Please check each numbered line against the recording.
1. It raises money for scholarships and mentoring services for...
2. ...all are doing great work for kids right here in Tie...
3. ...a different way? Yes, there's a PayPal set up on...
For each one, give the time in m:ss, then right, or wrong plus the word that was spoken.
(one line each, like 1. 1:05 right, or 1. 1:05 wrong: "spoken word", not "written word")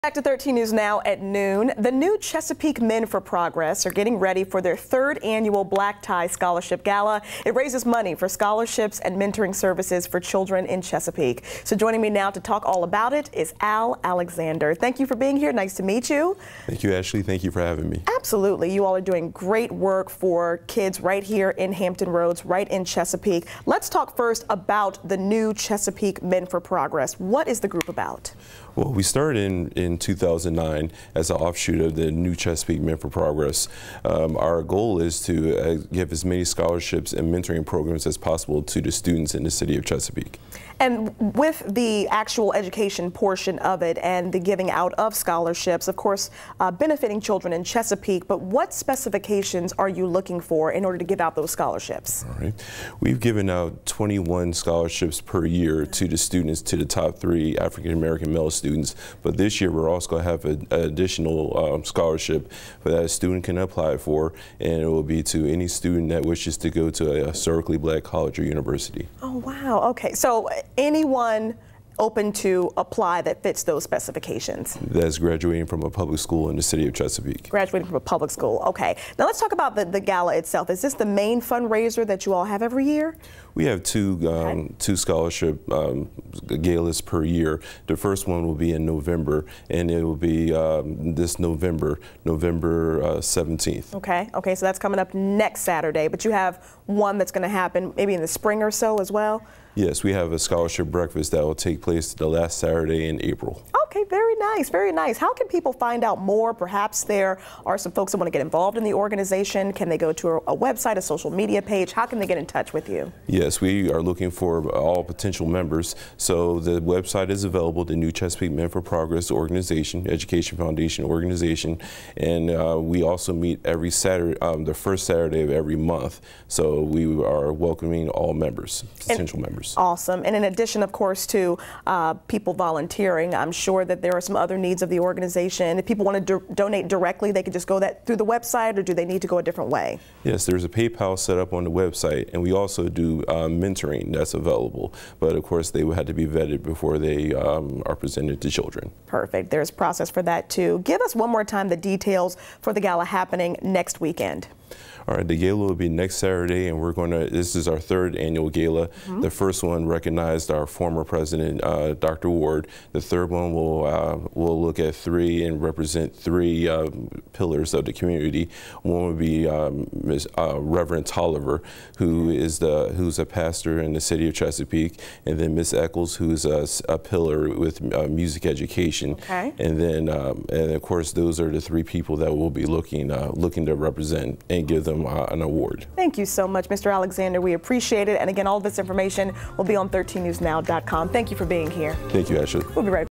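1. 0:07 right
2. 0:18 wrong: "Hampton", not "Tie"
3. 2:19 right.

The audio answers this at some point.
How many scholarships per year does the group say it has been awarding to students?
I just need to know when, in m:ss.
0:53.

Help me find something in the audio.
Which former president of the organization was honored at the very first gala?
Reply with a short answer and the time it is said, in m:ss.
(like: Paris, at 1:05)
Dr. Ward, at 2:41.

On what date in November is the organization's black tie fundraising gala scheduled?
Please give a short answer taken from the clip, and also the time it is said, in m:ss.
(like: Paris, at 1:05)
November 17, at 1:32.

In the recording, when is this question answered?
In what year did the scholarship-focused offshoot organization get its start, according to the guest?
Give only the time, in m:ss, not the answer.
0:29.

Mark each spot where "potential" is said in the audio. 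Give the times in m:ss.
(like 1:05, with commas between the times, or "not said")
1:55, 2:09.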